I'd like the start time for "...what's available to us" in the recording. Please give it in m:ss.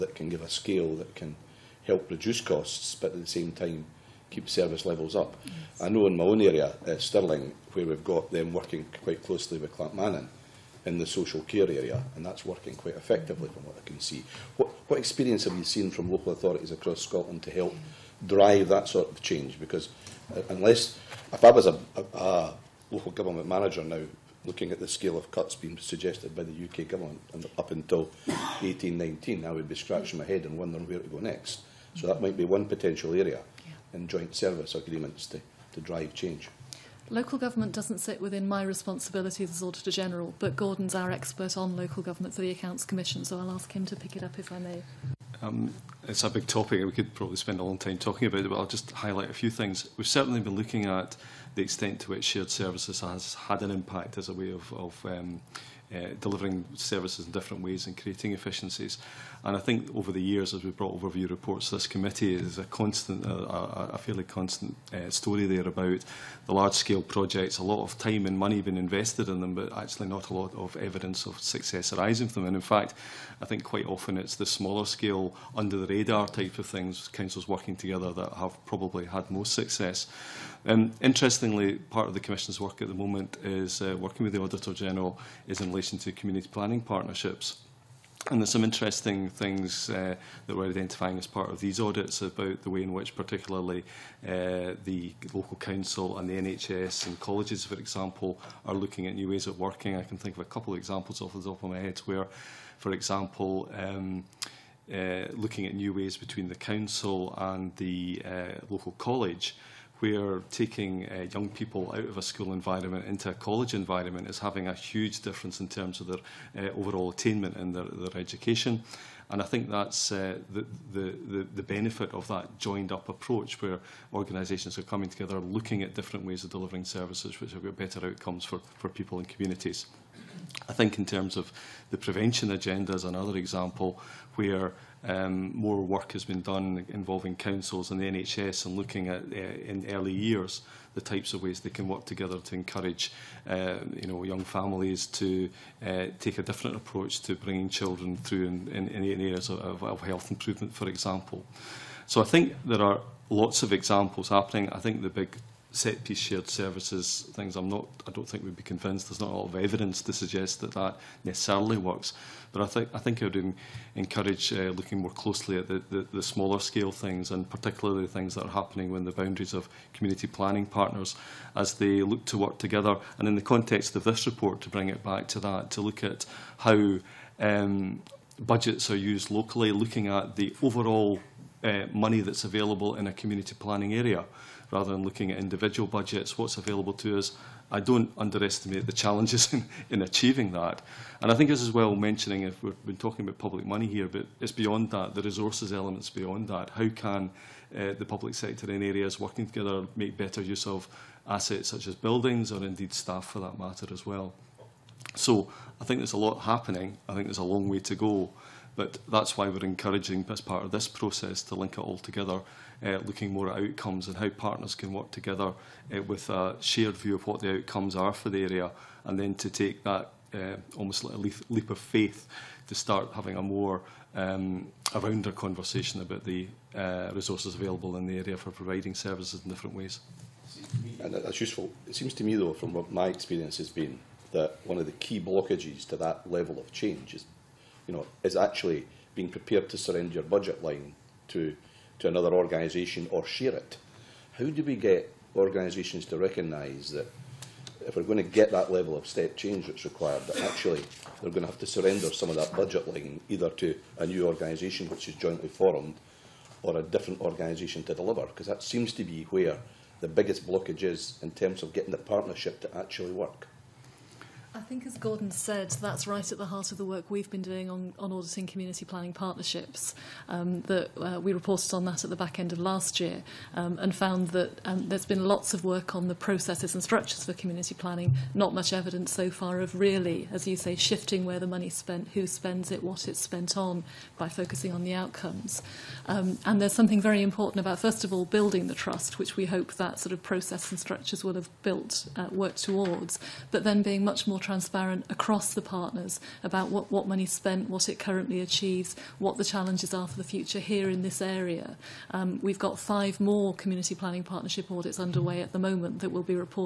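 3:06.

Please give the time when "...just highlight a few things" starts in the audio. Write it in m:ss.
0:48.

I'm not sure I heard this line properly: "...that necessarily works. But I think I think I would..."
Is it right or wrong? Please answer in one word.
right.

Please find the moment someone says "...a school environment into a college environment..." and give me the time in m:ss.
1:52.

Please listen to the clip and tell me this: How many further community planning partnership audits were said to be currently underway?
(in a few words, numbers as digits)
5.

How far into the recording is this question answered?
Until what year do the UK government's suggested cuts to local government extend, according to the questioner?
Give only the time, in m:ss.
0:28.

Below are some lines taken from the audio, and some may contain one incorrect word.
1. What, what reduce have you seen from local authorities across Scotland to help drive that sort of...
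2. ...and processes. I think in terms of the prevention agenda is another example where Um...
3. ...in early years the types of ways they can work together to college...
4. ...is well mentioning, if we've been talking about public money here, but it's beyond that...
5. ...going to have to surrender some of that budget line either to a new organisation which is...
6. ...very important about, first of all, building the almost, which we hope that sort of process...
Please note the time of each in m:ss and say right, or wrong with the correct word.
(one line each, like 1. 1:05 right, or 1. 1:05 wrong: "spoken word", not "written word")
1. 0:14 wrong: "experience", not "reduce"
2. 2:09 wrong: "communities", not "processes"
3. 2:19 wrong: "encourage", not "college"
4. 3:11 right
5. 4:11 right
6. 4:47 wrong: "trust", not "almost".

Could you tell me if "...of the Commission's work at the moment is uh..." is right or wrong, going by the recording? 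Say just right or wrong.
right.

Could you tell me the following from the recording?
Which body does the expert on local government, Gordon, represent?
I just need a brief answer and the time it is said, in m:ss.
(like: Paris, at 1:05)
Accounts Commission, at 0:42.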